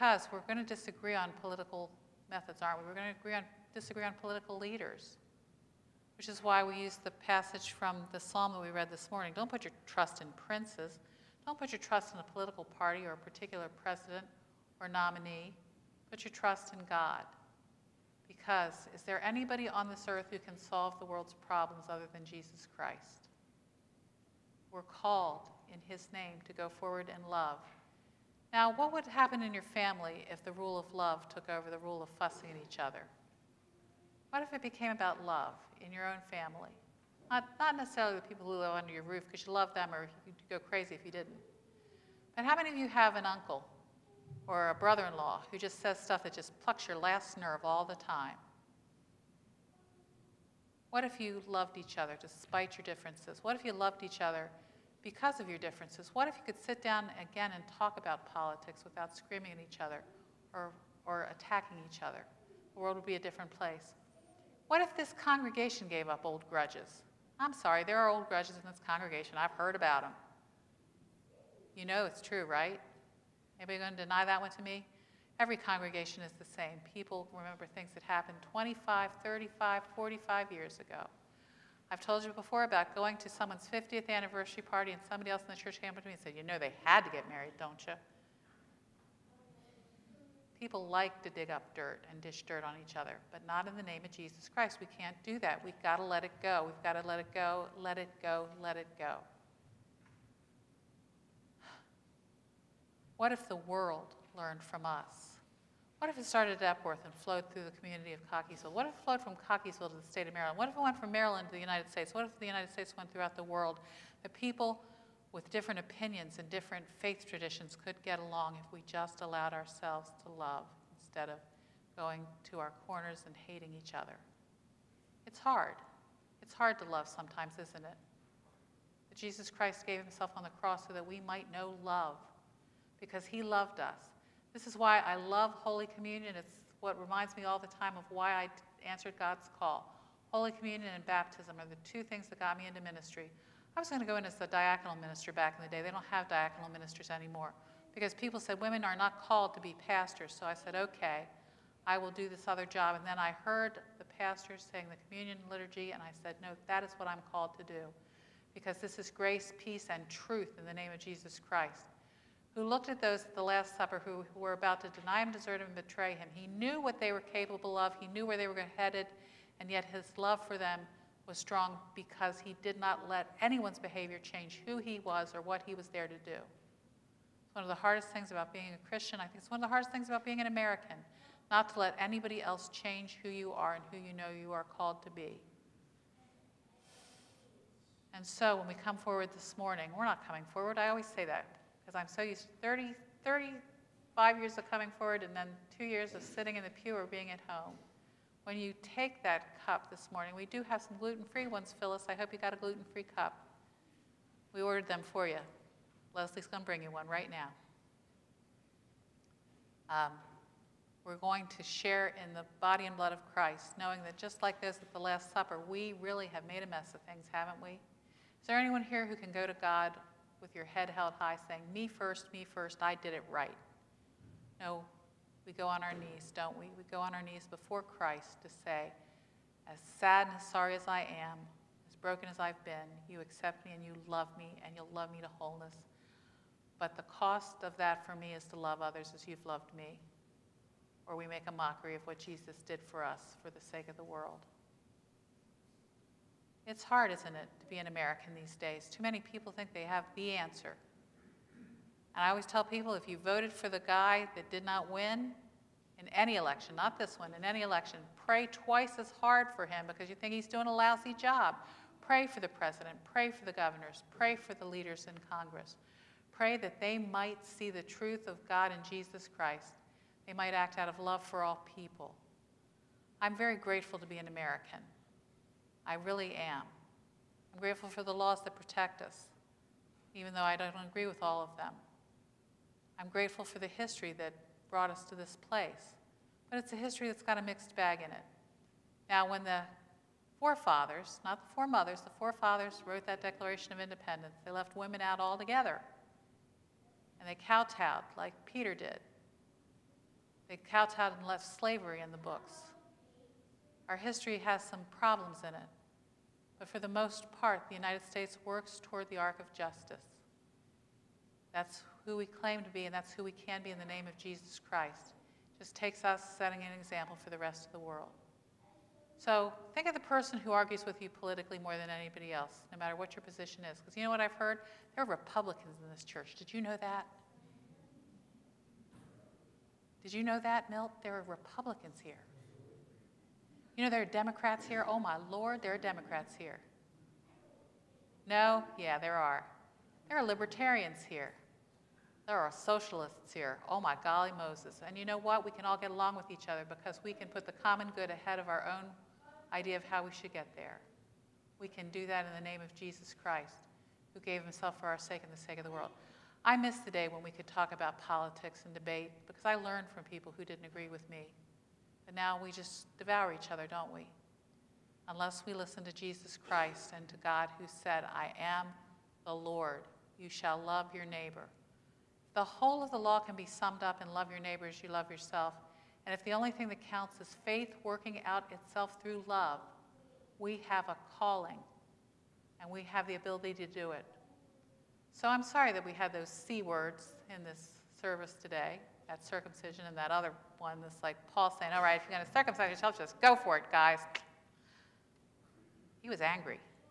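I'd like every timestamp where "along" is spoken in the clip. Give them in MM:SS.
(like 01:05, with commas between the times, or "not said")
01:58, 05:45.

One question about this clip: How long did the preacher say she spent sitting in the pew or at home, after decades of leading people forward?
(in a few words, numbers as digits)
2 years.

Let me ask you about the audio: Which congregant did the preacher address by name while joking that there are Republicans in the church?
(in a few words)
Milt.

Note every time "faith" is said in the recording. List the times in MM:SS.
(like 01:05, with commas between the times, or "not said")
01:56, 06:17.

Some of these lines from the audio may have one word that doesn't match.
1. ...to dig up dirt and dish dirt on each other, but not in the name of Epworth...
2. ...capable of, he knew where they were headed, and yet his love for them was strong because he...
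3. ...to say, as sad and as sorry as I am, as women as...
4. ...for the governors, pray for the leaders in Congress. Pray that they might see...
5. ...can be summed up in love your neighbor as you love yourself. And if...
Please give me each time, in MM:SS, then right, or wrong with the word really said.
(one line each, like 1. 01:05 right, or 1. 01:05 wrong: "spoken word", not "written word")
1. 01:31 wrong: "Jesus", not "Epworth"
2. 02:47 right
3. 03:48 wrong: "broken", not "women"
4. 04:23 right
5. 06:13 right.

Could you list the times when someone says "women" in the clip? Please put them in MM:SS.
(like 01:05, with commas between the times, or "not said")
02:28, 04:54.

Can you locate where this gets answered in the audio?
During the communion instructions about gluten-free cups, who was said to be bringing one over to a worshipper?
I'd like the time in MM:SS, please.
03:26.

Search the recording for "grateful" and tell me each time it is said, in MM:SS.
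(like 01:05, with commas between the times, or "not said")
04:33, 04:37, 04:43.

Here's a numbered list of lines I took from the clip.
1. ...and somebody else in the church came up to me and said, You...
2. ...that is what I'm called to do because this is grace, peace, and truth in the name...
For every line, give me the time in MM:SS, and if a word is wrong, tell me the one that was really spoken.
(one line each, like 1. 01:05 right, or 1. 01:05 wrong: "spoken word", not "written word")
1. 01:24 right
2. 02:36 right.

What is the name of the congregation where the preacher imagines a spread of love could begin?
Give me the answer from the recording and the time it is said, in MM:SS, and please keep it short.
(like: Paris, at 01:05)
Epworth, at 01:46.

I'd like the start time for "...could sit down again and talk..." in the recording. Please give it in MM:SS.
00:56.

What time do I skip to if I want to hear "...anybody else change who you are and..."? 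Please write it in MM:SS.
03:01.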